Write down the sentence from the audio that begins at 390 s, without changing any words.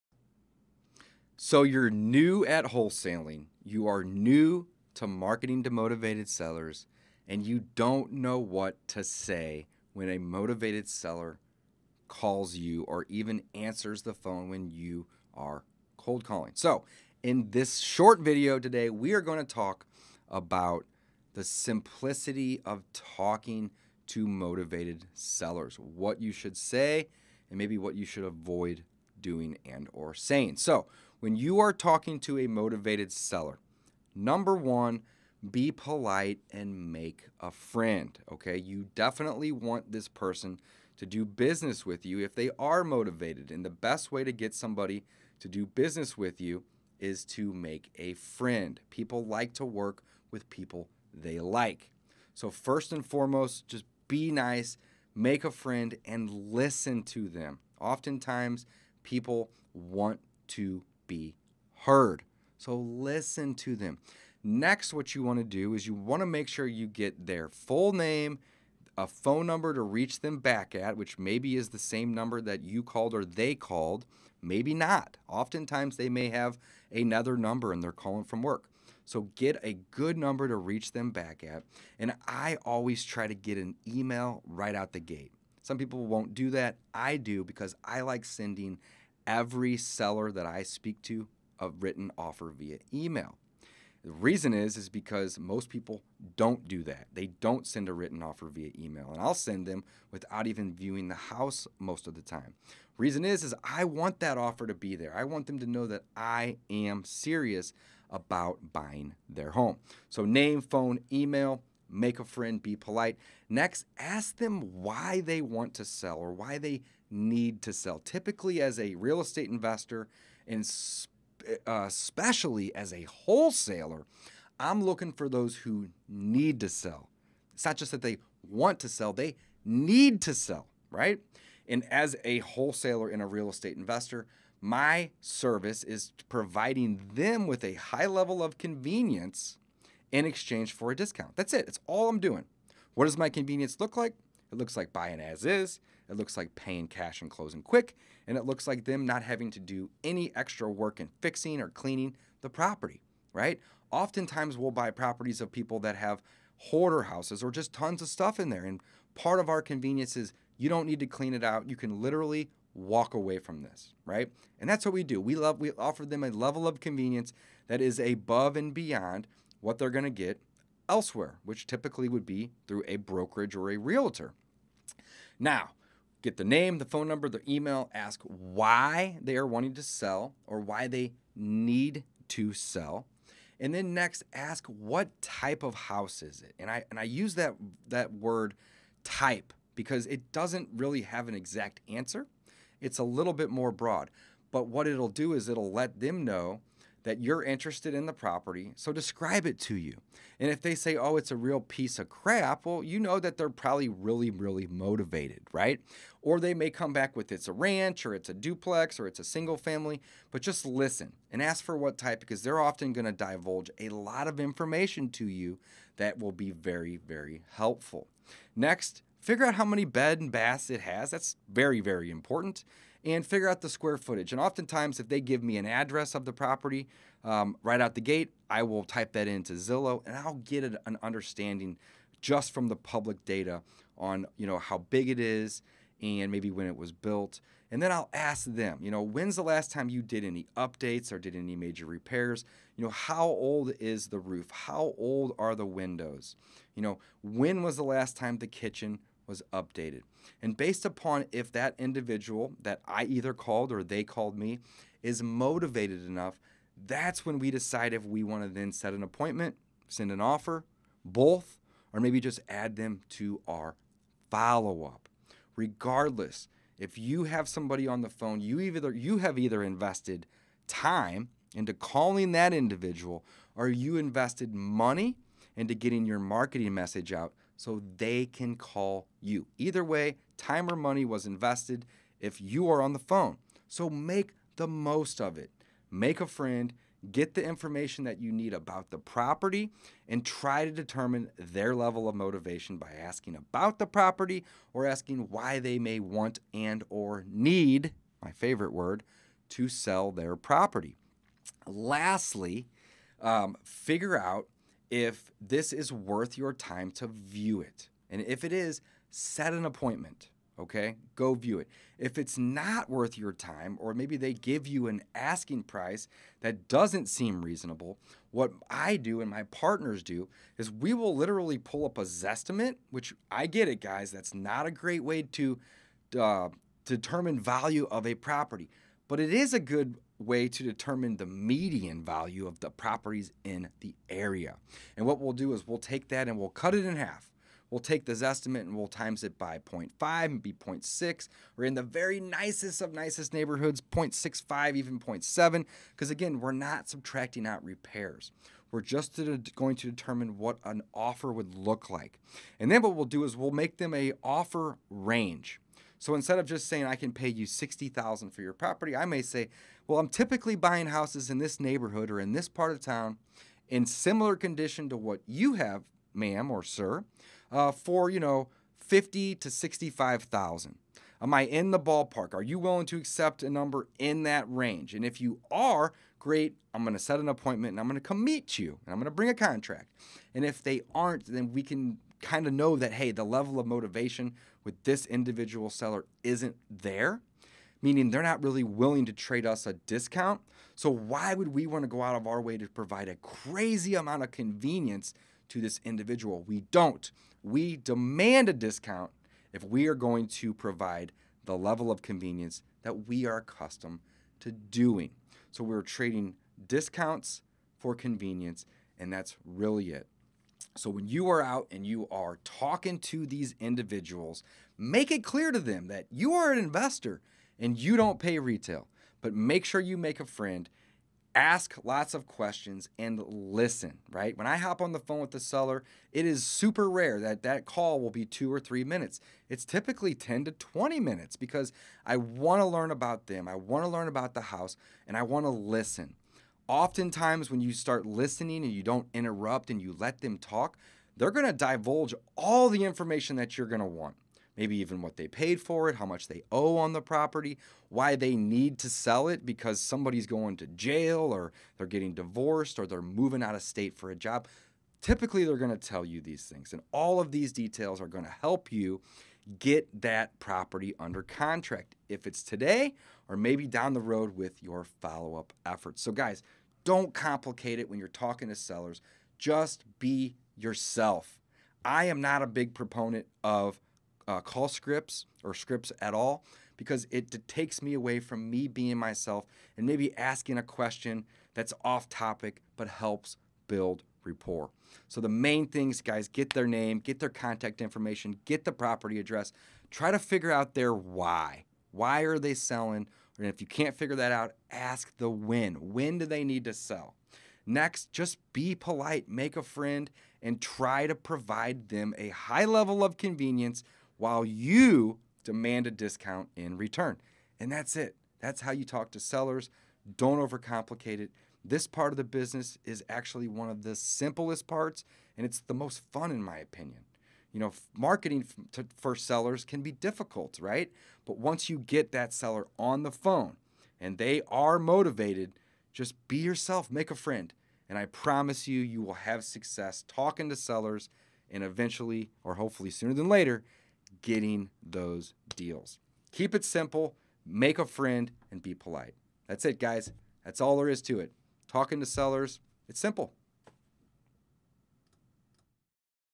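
So, why would we want to go out of our way to provide a crazy amount of convenience to this individual?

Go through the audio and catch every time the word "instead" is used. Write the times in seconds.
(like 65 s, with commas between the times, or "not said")
356 s.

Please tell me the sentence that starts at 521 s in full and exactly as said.
But once you get that seller on the phone and they are motivated, just be yourself, make a friend.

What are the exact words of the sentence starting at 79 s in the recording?
So get a good number to reach them back at.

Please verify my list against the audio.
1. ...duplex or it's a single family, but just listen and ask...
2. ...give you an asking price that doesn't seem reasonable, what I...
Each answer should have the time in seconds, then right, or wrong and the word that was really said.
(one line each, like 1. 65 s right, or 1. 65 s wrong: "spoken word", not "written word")
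1. 208 s right
2. 314 s right.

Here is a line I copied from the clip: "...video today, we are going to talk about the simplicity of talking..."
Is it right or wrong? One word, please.
right.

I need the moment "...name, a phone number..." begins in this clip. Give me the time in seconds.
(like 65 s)
67 s.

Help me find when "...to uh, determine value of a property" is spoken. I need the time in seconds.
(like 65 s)
325 s.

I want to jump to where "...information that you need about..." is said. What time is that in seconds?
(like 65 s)
287 s.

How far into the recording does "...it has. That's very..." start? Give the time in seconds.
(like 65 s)
220 s.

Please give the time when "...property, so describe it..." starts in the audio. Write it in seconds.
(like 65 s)
198 s.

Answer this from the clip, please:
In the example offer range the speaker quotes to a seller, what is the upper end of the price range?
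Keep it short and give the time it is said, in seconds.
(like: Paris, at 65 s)
65,000, at 369 s.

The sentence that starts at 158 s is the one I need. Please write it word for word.
And part of our convenience is you don't need to clean it out.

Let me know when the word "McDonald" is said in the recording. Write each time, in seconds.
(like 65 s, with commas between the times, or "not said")
not said.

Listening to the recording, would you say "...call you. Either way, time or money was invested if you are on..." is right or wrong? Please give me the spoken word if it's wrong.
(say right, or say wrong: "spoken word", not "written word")
right.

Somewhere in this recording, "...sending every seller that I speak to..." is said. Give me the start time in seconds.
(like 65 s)
88 s.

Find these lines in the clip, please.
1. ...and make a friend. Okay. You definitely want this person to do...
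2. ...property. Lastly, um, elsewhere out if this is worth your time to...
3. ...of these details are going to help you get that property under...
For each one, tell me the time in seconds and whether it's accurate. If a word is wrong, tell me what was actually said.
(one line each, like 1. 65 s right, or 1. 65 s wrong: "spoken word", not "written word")
1. 36 s right
2. 300 s wrong: "figure", not "elsewhere"
3. 457 s right.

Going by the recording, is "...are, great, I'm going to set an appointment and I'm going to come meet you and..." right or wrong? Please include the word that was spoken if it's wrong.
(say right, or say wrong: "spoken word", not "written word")
right.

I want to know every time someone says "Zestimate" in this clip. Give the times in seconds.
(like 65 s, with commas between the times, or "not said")
322 s, 338 s.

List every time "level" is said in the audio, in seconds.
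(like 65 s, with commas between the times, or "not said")
138 s, 166 s, 291 s, 383 s, 401 s, 502 s.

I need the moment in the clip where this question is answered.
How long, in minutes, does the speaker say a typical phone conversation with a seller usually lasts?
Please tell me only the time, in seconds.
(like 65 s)
430 s.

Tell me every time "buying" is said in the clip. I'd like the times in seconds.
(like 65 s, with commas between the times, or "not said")
108 s, 144 s, 360 s.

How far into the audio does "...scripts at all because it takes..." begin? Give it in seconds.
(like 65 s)
475 s.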